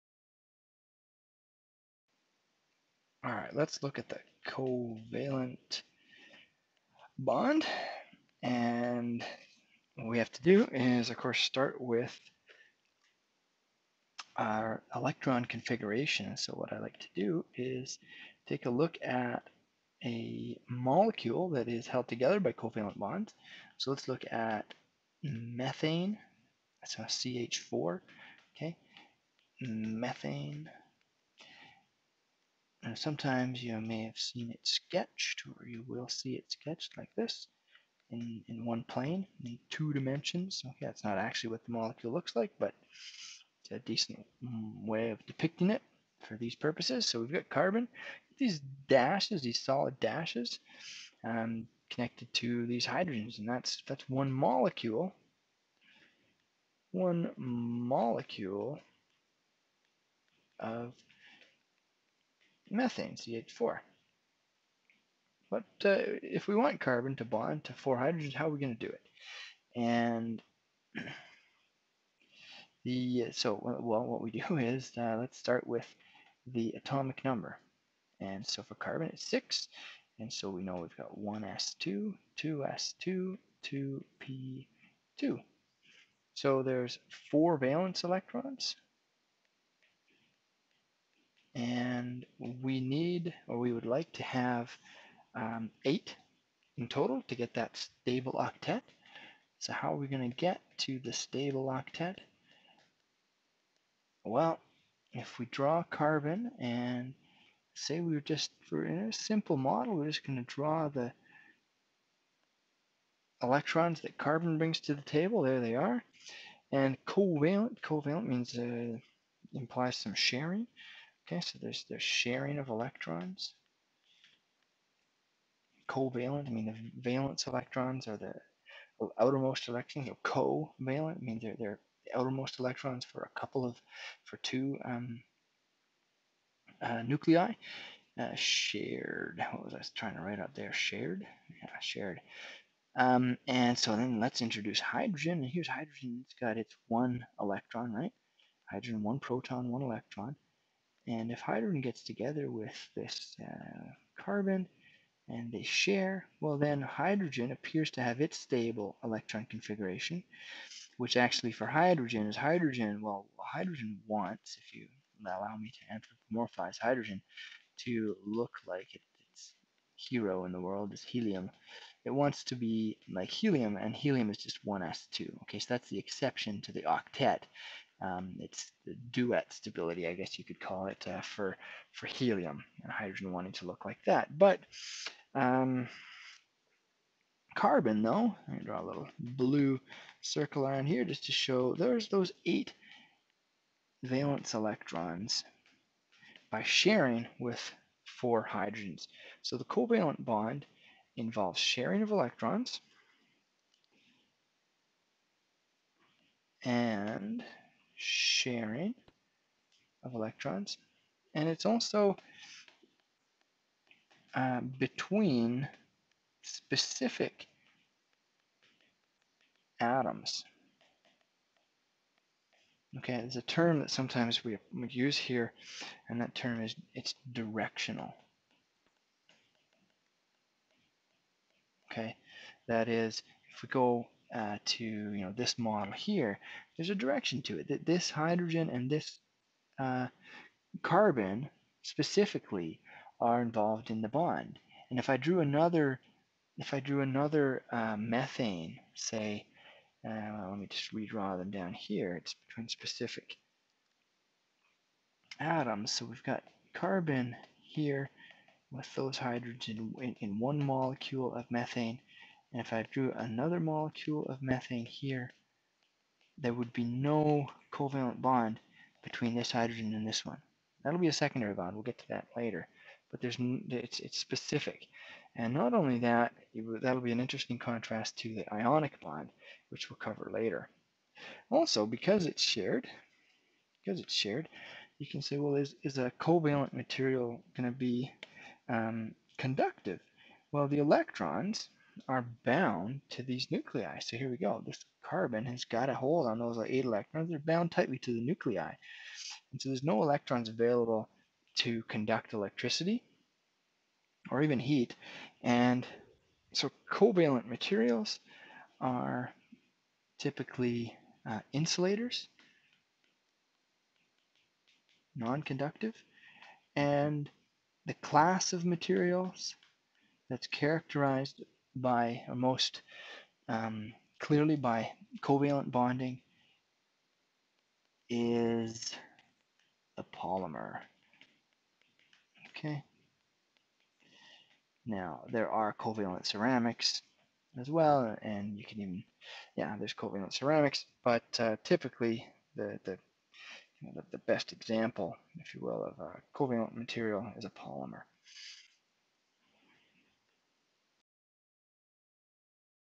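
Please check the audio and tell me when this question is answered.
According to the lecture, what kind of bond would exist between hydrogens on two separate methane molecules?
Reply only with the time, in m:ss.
4:31.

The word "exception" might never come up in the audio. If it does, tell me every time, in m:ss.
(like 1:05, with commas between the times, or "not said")
2:55.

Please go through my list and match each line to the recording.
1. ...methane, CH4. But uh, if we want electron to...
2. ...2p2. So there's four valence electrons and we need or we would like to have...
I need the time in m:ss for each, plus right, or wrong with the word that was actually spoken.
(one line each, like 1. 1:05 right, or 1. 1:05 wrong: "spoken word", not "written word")
1. 1:02 wrong: "carbon", not "electron"
2. 1:23 right.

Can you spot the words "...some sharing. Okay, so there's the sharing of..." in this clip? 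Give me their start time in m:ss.
1:59.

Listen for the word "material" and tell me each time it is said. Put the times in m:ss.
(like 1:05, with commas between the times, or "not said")
4:46, 5:07, 5:18, 5:46.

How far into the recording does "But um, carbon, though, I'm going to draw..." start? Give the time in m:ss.
3:04.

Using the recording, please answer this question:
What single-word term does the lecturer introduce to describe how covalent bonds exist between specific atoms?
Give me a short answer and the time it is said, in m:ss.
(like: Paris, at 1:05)
directional, at 3:47.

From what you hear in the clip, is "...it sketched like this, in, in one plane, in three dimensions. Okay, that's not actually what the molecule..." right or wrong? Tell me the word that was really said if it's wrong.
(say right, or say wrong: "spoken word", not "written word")
wrong: "two", not "three".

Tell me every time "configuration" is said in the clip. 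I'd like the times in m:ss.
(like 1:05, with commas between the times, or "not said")
0:15, 2:39.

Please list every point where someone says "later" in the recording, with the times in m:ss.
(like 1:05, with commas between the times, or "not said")
4:32, 4:40.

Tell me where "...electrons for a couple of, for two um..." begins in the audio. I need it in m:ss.
2:12.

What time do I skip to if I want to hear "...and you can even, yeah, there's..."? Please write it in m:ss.
5:38.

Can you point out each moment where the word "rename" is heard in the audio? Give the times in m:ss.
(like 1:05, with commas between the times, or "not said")
not said.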